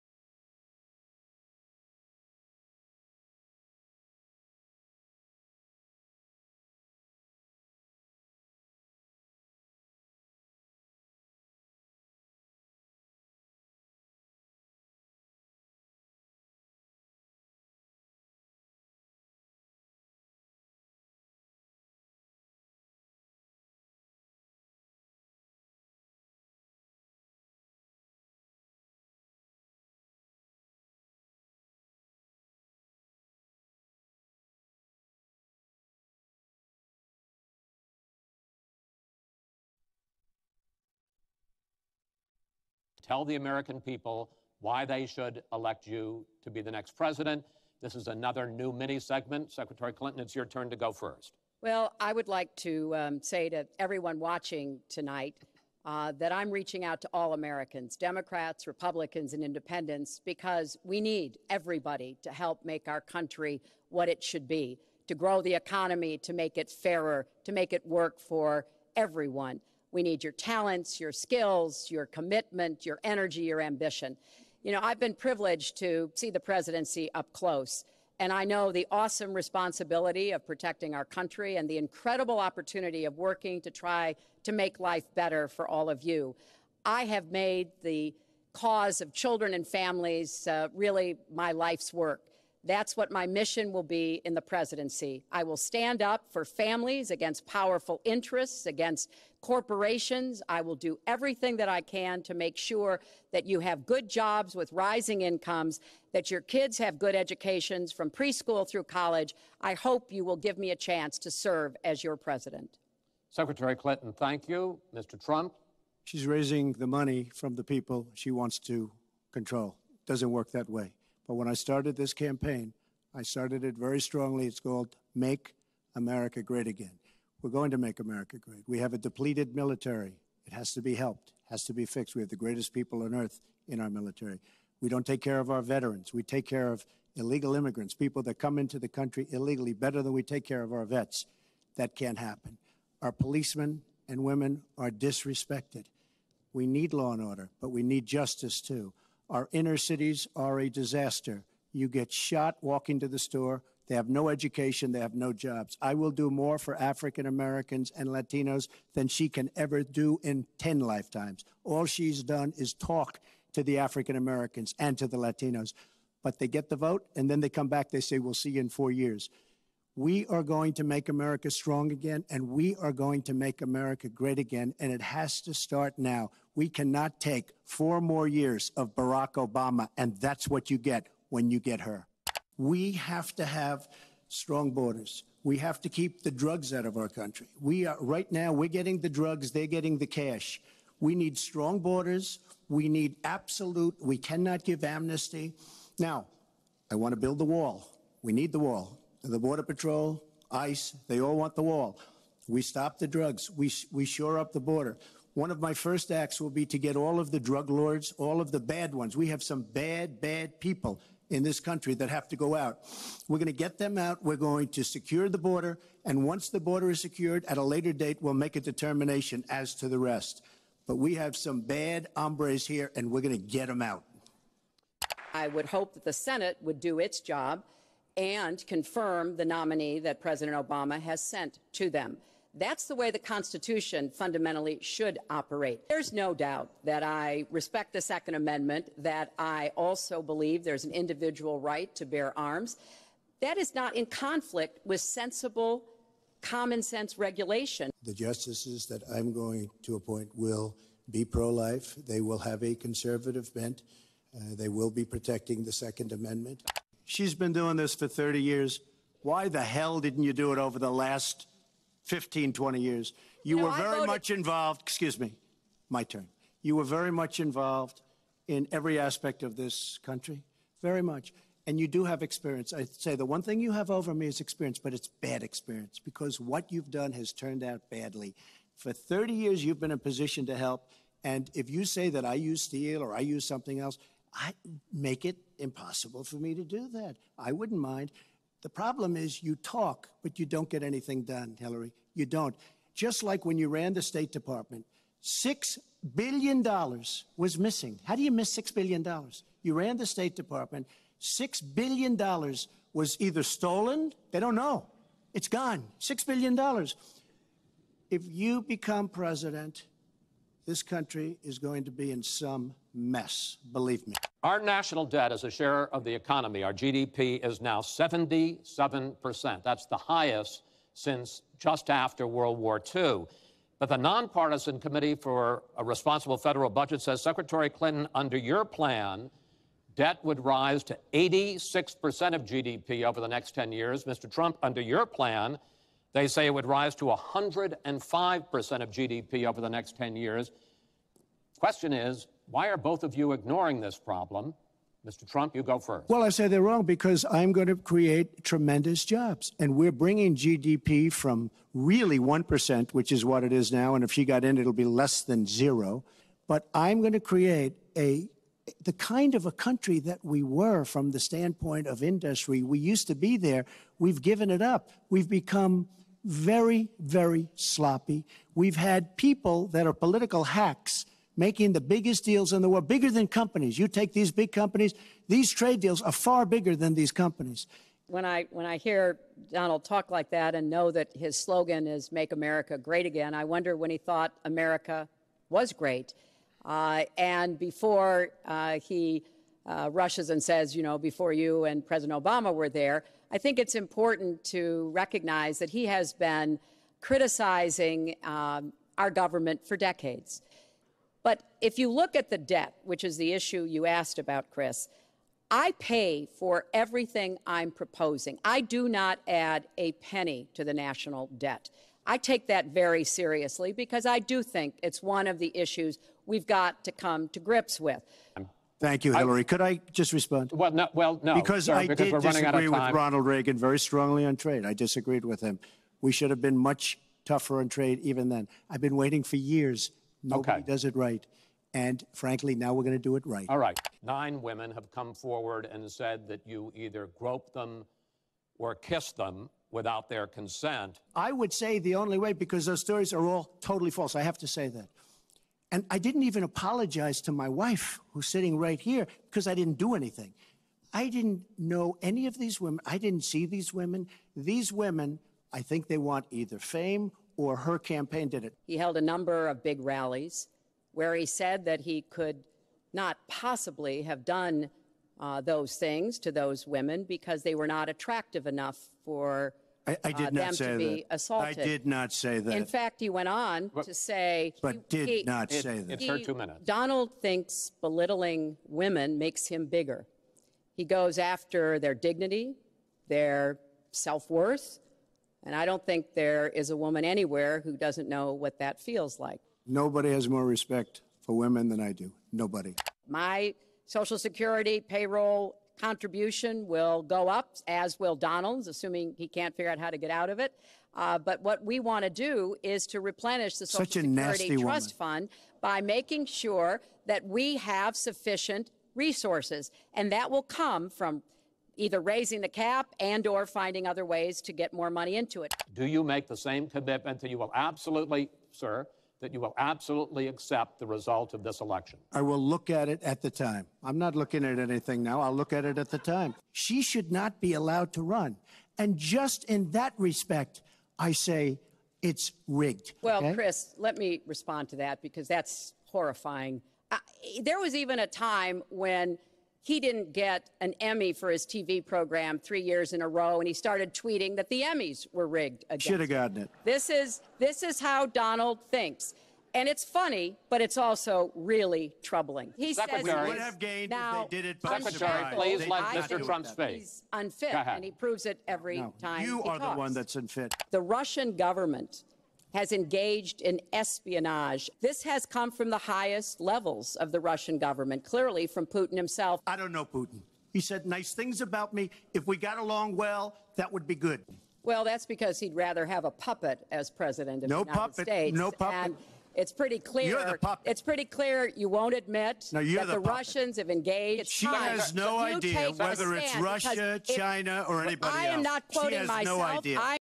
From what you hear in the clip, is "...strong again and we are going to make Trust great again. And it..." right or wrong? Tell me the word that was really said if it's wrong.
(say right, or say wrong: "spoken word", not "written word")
wrong: "America", not "Trust".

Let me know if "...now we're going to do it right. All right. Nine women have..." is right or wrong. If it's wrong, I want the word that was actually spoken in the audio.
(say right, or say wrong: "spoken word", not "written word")
right.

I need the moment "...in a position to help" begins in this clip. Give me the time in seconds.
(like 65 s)
279 s.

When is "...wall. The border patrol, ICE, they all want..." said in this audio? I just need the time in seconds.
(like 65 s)
198 s.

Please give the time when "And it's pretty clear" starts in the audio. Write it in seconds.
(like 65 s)
578 s.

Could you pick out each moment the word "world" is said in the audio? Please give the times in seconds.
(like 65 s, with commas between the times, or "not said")
322 s, 372 s.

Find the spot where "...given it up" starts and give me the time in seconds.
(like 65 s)
364 s.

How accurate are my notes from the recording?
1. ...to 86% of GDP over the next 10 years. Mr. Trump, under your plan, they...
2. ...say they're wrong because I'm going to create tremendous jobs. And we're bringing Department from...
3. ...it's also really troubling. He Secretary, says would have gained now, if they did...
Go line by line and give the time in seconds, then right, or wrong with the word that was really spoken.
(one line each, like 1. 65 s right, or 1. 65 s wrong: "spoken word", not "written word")
1. 330 s right
2. 346 s wrong: "GDP", not "Department"
3. 550 s right.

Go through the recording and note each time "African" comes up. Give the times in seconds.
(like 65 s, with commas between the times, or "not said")
156 s, 163 s.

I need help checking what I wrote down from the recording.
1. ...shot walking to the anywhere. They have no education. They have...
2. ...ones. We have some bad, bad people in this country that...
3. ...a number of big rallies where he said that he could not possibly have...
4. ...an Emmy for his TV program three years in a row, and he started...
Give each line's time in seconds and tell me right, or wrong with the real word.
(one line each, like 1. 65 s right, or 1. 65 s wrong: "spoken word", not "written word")
1. 152 s wrong: "store", not "anywhere"
2. 208 s right
3. 458 s right
4. 540 s right.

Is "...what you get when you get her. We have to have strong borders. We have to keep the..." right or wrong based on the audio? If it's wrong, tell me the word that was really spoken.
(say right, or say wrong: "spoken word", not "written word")
right.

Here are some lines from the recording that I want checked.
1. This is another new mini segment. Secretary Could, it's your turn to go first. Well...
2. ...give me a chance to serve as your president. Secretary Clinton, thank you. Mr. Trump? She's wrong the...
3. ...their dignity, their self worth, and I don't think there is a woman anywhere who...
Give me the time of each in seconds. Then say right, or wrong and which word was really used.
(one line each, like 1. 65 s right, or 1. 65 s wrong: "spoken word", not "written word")
1. 47 s wrong: "Clinton", not "Could"
2. 110 s wrong: "raising", not "wrong"
3. 481 s right.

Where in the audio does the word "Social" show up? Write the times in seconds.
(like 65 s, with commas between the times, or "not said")
493 s, 503 s.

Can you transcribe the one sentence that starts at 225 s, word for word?
I would hope that the Senate would do its job and confirm the nominee that President Obama has sent to them.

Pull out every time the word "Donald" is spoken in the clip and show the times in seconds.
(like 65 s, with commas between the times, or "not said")
379 s, 476 s, 498 s, 548 s.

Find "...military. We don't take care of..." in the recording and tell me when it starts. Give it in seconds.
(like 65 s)
133 s.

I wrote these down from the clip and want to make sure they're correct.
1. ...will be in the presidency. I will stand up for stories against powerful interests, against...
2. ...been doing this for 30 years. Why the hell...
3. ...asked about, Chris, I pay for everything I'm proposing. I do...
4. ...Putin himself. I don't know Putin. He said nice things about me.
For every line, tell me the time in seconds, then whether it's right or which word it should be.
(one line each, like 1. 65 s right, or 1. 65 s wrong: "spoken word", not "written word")
1. 93 s wrong: "families", not "stories"
2. 257 s right
3. 403 s right
4. 568 s right.